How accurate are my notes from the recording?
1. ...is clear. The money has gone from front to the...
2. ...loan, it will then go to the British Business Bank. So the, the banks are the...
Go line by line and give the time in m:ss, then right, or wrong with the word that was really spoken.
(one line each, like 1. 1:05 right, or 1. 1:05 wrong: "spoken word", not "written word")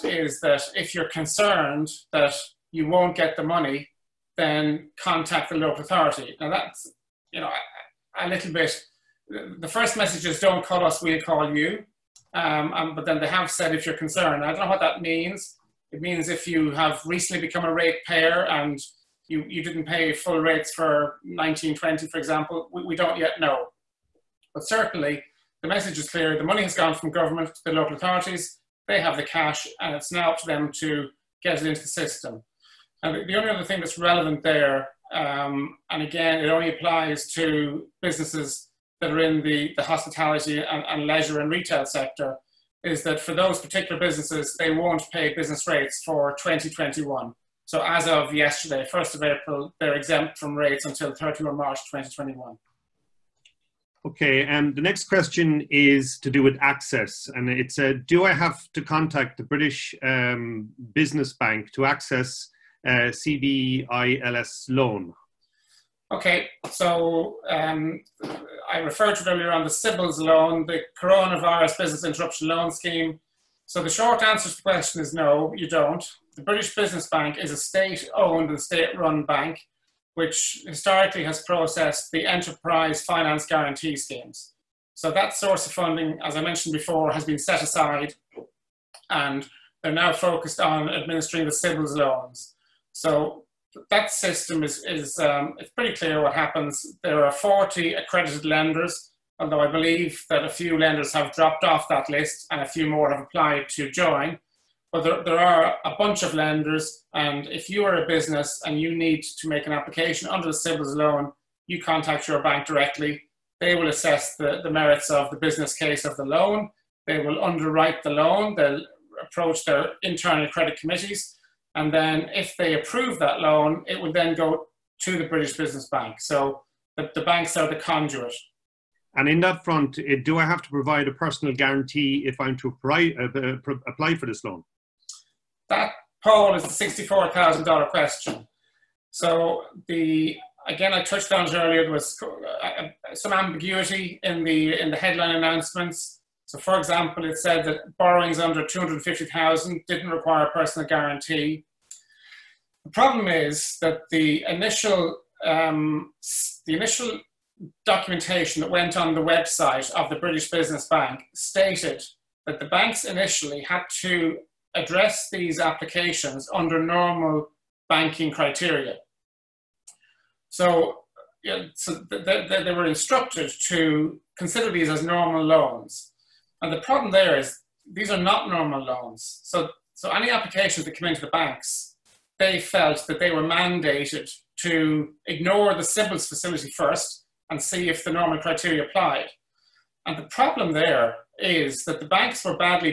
1. 0:25 wrong: "government", not "front"
2. 2:03 right.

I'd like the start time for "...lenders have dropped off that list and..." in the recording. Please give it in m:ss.
1:40.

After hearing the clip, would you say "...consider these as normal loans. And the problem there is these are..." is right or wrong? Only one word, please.
right.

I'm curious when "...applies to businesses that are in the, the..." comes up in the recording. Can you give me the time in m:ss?
0:36.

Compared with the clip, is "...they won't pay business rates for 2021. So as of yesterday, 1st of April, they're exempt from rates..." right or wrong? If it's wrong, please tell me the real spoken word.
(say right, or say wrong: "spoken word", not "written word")
right.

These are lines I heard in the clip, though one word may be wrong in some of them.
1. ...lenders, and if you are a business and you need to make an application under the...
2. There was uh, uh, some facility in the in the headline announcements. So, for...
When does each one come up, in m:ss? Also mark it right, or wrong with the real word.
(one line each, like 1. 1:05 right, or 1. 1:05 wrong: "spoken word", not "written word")
1. 1:46 right
2. 2:21 wrong: "ambiguity", not "facility".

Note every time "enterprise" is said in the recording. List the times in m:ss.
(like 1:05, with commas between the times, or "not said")
1:22.